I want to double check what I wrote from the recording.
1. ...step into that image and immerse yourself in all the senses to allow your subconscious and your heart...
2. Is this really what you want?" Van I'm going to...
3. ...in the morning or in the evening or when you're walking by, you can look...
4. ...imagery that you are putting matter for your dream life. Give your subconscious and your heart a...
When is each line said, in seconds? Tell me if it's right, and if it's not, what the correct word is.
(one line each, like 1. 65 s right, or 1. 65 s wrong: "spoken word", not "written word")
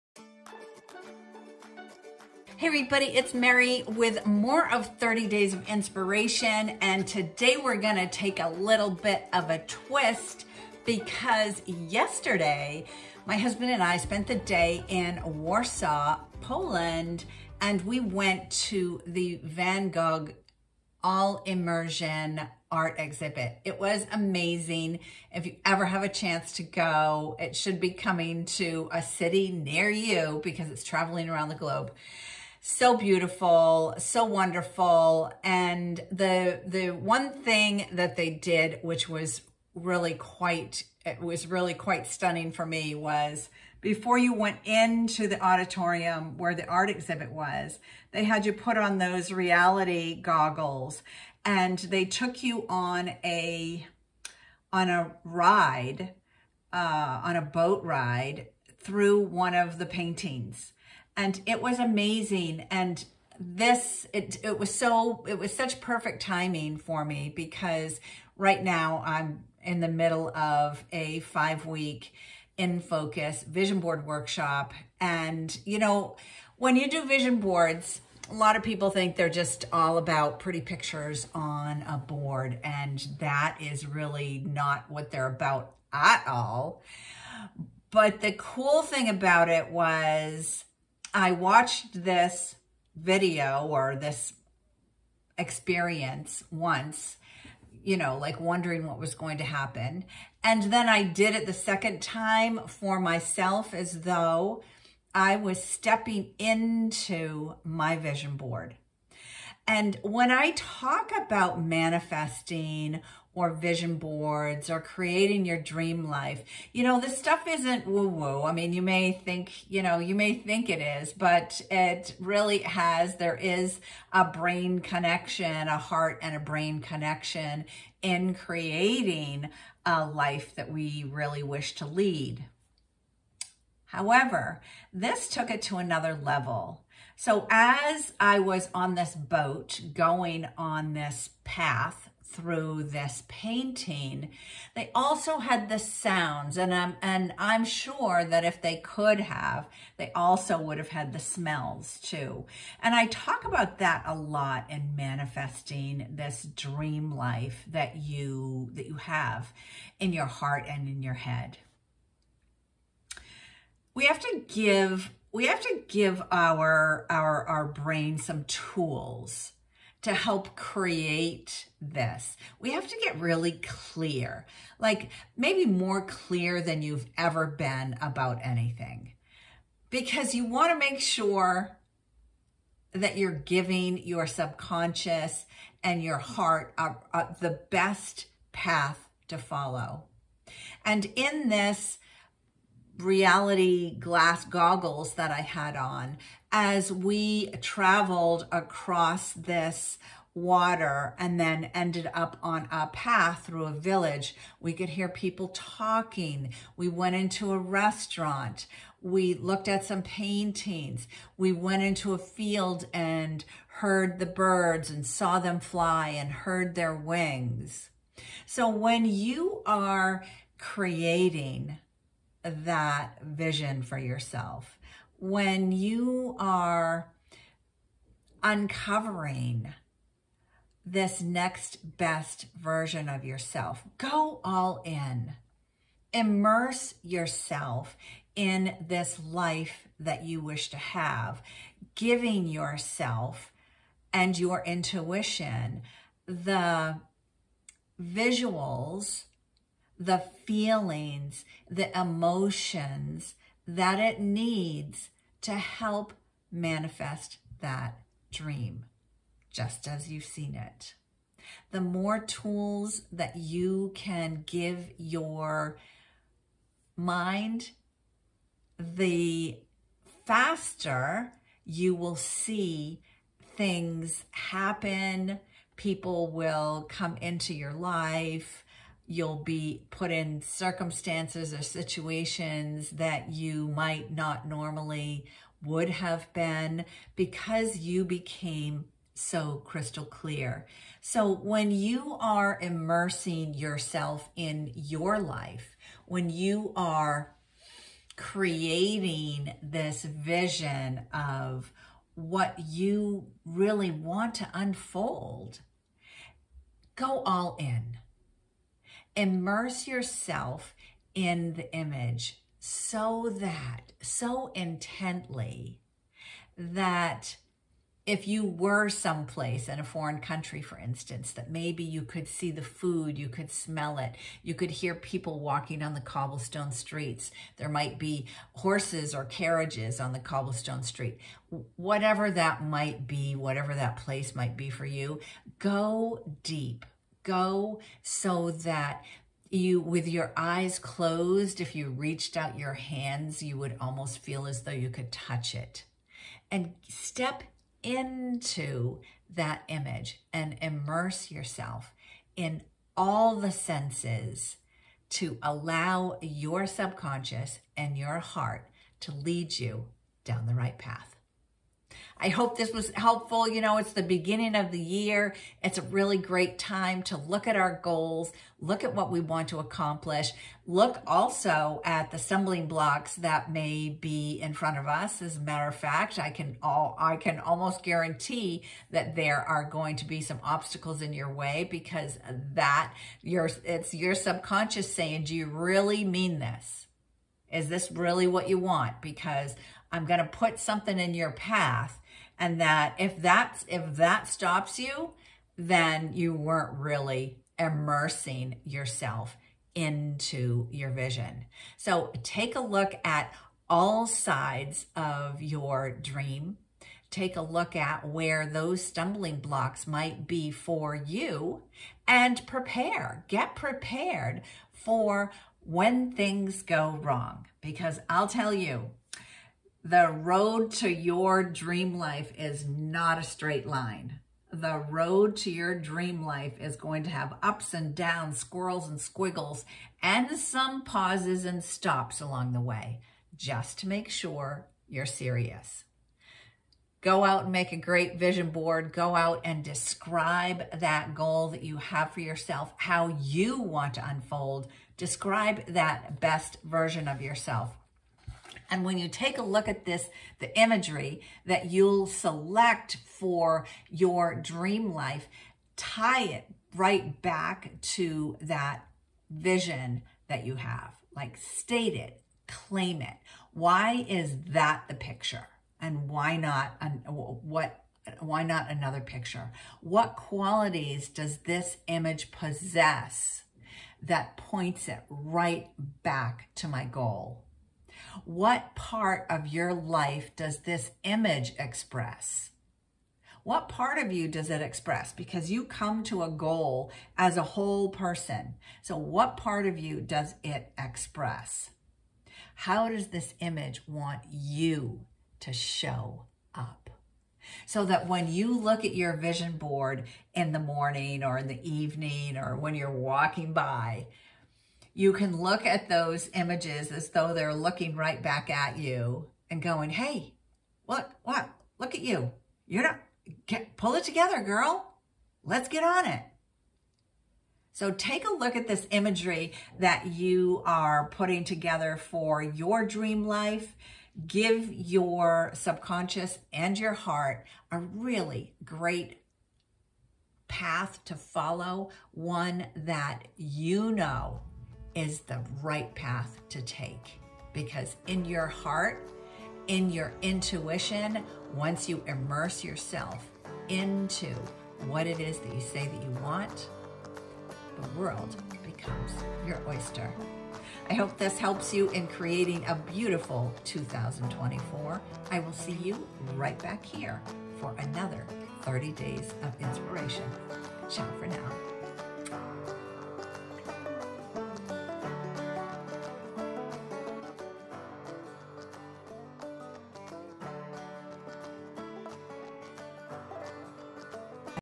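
1. 346 s right
2. 387 s wrong: "Because", not "Van"
3. 500 s right
4. 518 s wrong: "together", not "matter".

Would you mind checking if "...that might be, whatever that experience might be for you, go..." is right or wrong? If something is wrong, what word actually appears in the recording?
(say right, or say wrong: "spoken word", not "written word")
wrong: "place", not "experience".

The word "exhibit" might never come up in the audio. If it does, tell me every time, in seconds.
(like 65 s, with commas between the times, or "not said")
22 s, 46 s.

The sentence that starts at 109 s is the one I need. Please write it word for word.
And when I talk about manifesting or vision boards or creating your dream life.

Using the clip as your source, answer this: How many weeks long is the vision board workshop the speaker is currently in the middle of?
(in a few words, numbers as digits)
5.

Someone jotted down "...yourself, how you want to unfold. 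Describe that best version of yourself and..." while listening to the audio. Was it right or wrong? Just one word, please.
right.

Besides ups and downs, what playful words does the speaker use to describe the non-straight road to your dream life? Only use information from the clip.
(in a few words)
Squirrels and squiggles.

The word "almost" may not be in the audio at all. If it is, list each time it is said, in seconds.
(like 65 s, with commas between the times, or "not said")
343 s, 377 s.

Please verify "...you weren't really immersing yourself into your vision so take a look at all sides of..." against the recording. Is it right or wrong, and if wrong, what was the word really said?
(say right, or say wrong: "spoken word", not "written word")
right.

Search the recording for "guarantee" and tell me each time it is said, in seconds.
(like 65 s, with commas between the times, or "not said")
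377 s.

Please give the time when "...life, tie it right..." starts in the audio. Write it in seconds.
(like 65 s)
454 s.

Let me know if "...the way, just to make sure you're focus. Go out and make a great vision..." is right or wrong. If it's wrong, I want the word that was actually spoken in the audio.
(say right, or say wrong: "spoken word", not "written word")
wrong: "serious", not "focus".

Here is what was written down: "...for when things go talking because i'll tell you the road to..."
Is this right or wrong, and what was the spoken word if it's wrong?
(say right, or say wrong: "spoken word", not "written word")
wrong: "wrong", not "talking".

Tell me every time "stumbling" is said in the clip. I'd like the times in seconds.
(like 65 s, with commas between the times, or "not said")
372 s, 408 s.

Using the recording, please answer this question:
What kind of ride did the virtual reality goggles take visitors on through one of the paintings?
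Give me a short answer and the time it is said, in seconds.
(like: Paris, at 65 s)
A boat ride, at 57 s.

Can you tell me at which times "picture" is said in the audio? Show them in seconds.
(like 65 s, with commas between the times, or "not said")
80 s, 464 s, 469 s.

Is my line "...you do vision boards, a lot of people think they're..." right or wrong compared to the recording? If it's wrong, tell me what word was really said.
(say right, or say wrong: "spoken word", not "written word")
right.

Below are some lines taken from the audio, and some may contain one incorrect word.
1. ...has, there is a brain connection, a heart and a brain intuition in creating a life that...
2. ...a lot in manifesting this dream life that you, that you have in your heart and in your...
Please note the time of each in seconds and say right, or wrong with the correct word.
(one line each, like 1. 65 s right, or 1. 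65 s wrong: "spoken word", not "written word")
1. 122 s wrong: "connection", not "intuition"
2. 154 s right.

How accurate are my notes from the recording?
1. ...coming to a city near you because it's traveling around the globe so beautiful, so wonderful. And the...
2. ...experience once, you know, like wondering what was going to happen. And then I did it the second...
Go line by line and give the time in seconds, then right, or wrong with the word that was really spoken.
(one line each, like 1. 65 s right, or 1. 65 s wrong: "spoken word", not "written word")
1. 27 s right
2. 95 s right.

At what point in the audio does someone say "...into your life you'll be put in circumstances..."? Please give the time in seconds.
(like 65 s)
277 s.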